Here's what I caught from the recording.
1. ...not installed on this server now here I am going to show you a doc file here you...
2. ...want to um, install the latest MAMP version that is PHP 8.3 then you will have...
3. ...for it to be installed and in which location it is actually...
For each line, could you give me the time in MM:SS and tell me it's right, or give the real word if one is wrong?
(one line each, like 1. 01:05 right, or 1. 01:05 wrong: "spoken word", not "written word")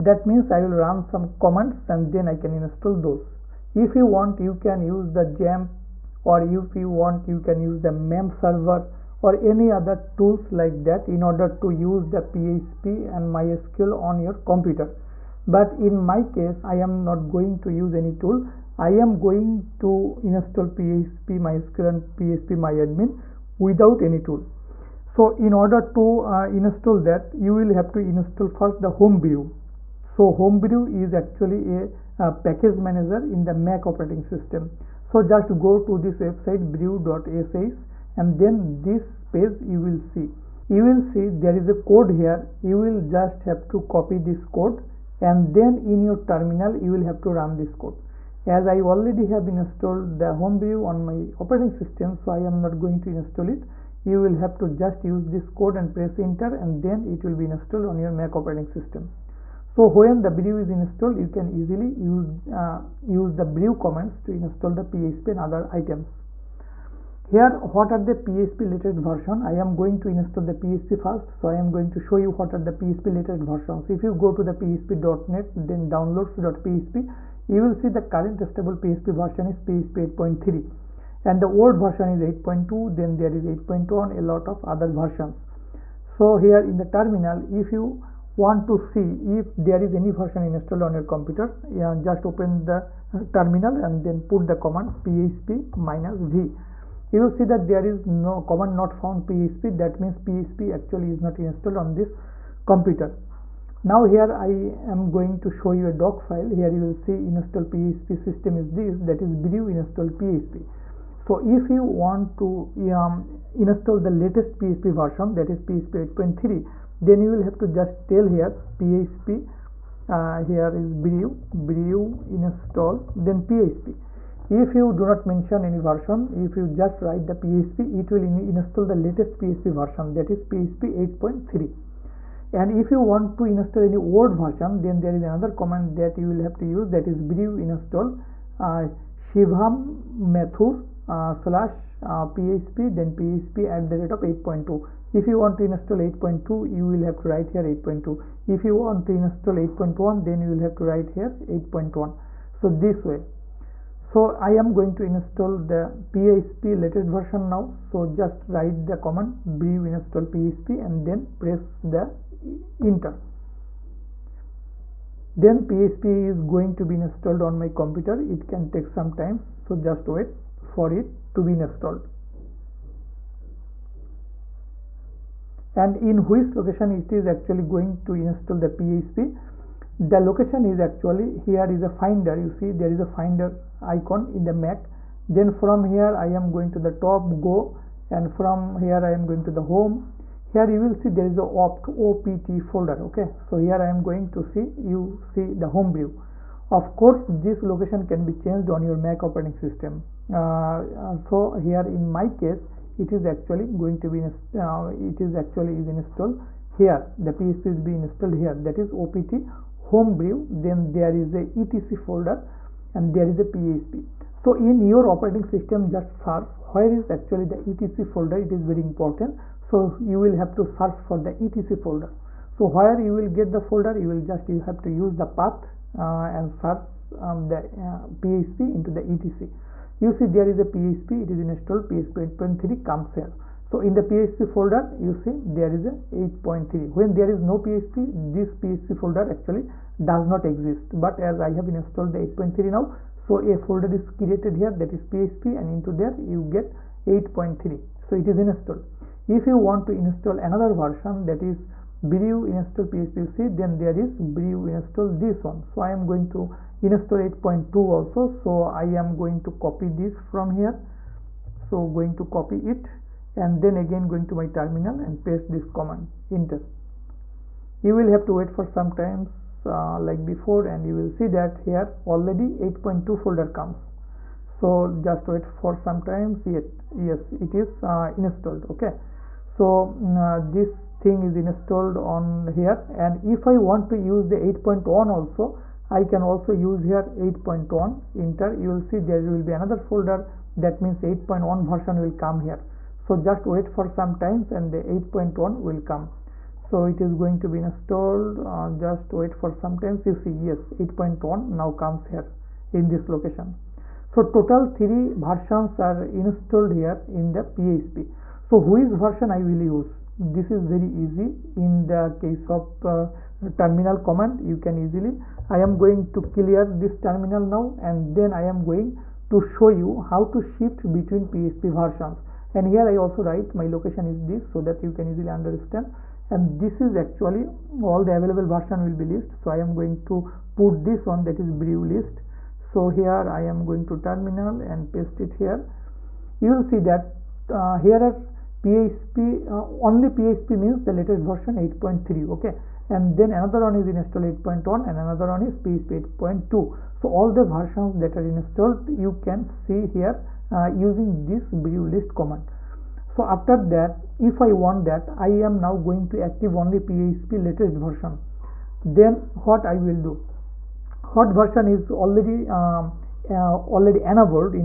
1. 01:41 wrong: "computer", not "server"
2. 01:51 wrong: "PHP", not "MAMP"
3. 02:50 right.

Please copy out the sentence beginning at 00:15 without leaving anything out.
But in my case, I am not going to use any tool.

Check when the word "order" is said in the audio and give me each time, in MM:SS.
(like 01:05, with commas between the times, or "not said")
00:11, 00:25.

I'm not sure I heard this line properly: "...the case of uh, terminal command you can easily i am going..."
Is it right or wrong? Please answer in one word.
right.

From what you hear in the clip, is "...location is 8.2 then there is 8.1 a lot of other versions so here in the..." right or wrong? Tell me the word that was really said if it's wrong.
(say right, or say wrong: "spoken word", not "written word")
wrong: "version", not "location".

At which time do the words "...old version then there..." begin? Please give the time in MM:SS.
02:13.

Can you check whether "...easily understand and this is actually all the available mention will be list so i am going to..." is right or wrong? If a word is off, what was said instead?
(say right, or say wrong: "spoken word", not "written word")
wrong: "version", not "mention".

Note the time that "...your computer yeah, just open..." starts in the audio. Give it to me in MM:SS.
01:30.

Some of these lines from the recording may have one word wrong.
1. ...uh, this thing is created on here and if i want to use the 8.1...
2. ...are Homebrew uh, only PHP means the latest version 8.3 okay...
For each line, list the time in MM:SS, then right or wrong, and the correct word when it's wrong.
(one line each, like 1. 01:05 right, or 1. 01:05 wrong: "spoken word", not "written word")
1. 04:40 wrong: "installed", not "created"
2. 05:38 wrong: "PHP", not "Homebrew".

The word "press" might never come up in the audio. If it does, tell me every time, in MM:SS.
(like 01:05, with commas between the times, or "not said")
00:55, 02:41.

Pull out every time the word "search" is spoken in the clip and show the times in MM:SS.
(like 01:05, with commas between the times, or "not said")
03:36, 03:40, 03:46.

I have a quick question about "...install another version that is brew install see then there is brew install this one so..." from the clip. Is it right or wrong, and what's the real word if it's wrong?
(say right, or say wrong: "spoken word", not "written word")
right.